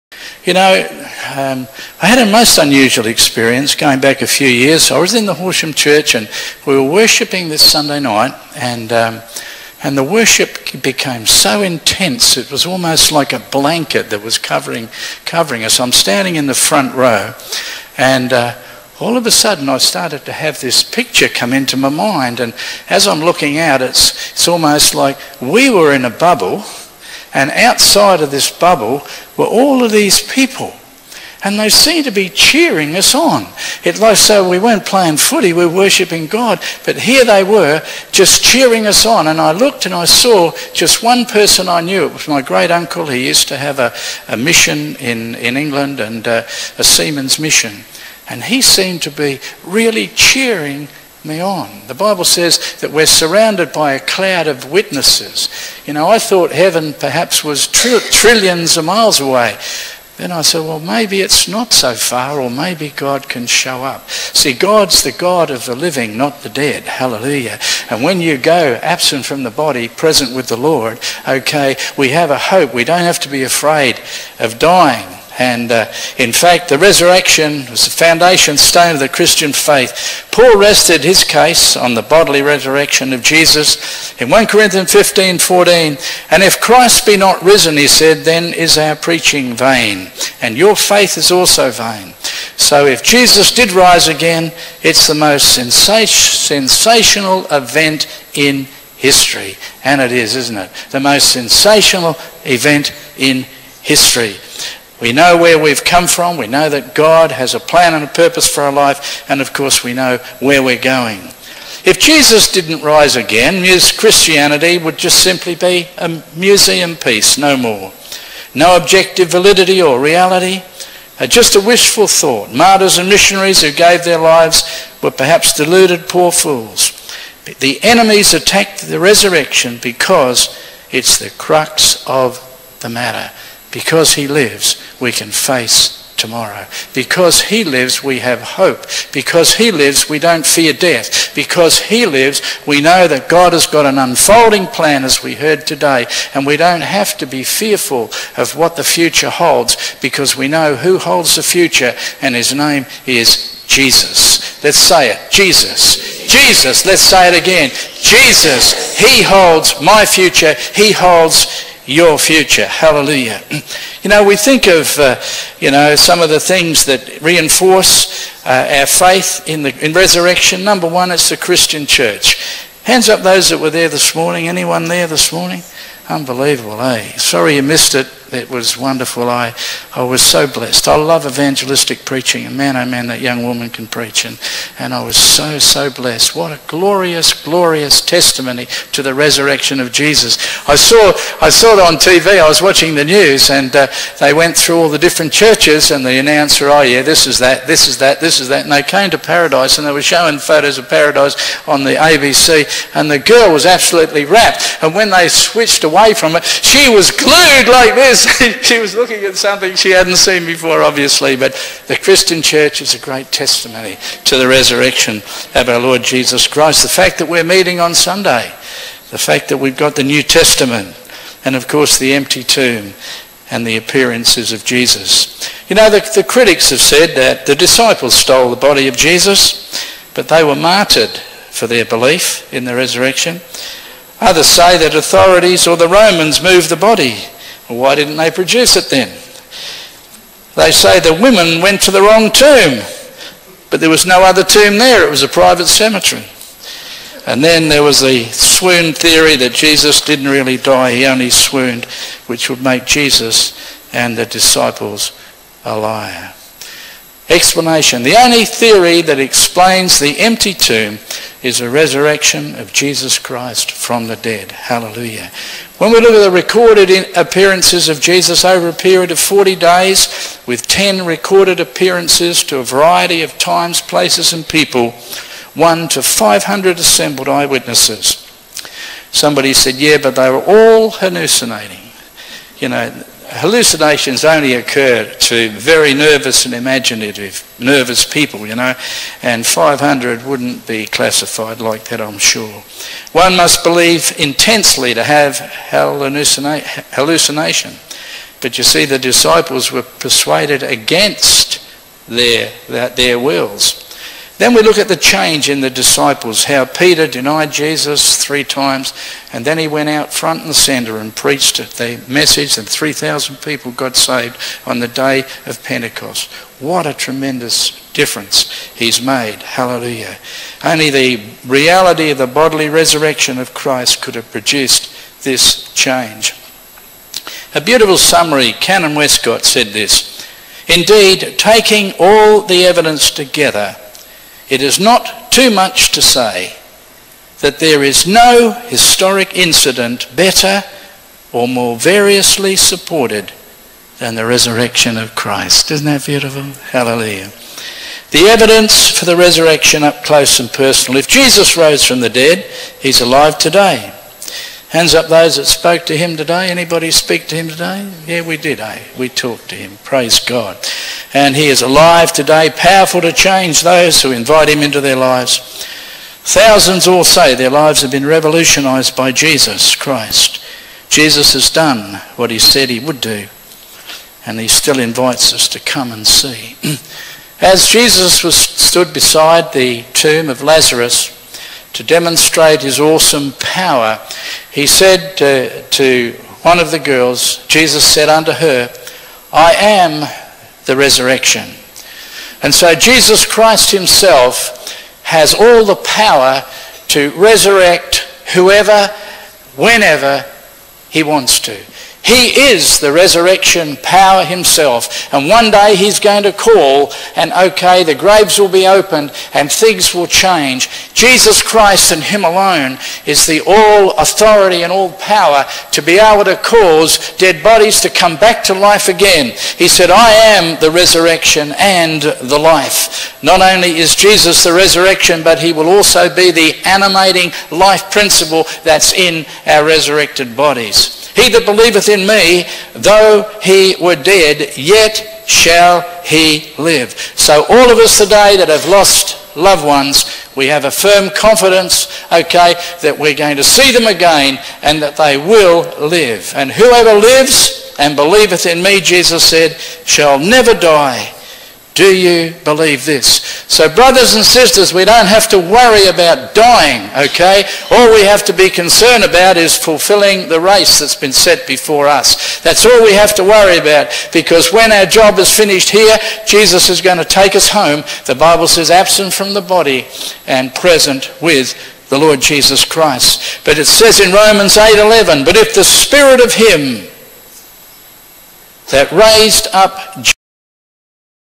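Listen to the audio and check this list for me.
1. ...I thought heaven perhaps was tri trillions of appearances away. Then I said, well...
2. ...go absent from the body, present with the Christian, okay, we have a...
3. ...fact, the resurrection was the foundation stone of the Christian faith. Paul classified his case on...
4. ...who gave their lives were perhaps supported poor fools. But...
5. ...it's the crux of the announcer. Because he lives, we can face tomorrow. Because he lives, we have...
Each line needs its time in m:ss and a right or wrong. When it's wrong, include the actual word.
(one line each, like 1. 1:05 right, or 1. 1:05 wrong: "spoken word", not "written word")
1. 0:56 wrong: "miles", not "appearances"
2. 1:08 wrong: "Lord", not "Christian"
3. 1:16 wrong: "rested", not "classified"
4. 2:03 wrong: "deluded", not "supported"
5. 2:10 wrong: "matter", not "announcer".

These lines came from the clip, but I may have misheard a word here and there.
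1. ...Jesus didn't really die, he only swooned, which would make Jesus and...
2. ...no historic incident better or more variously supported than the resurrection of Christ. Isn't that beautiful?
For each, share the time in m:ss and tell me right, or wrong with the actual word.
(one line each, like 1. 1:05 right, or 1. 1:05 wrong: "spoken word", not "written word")
1. 4:09 right
2. 5:38 right.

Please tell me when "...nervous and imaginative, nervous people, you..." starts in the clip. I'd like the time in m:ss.
4:45.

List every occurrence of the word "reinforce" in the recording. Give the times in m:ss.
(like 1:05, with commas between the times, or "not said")
2:47.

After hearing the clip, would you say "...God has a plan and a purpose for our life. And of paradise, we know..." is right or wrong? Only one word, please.
wrong.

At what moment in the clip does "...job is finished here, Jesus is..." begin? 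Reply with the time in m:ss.
7:44.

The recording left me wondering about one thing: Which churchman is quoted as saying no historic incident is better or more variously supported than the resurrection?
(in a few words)
Canon Westcott.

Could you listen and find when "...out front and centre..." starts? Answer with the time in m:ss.
5:09.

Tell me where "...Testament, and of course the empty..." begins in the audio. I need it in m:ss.
3:40.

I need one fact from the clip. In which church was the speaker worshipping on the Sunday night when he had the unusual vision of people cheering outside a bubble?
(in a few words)
Horsham Church.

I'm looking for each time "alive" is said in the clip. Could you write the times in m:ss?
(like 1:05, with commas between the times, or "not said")
5:52, 6:01.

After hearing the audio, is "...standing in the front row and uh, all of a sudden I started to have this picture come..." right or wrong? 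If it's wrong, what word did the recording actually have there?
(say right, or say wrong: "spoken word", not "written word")
right.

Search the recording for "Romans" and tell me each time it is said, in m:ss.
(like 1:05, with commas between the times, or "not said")
3:55, 7:54.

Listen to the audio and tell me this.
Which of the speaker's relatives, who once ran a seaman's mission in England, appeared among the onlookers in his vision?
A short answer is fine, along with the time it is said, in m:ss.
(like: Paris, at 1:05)
Great uncle, at 0:42.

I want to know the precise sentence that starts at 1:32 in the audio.
So if Jesus did rise again, it's the most sensational event in history.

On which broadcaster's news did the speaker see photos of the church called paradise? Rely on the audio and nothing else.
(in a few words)
ABC.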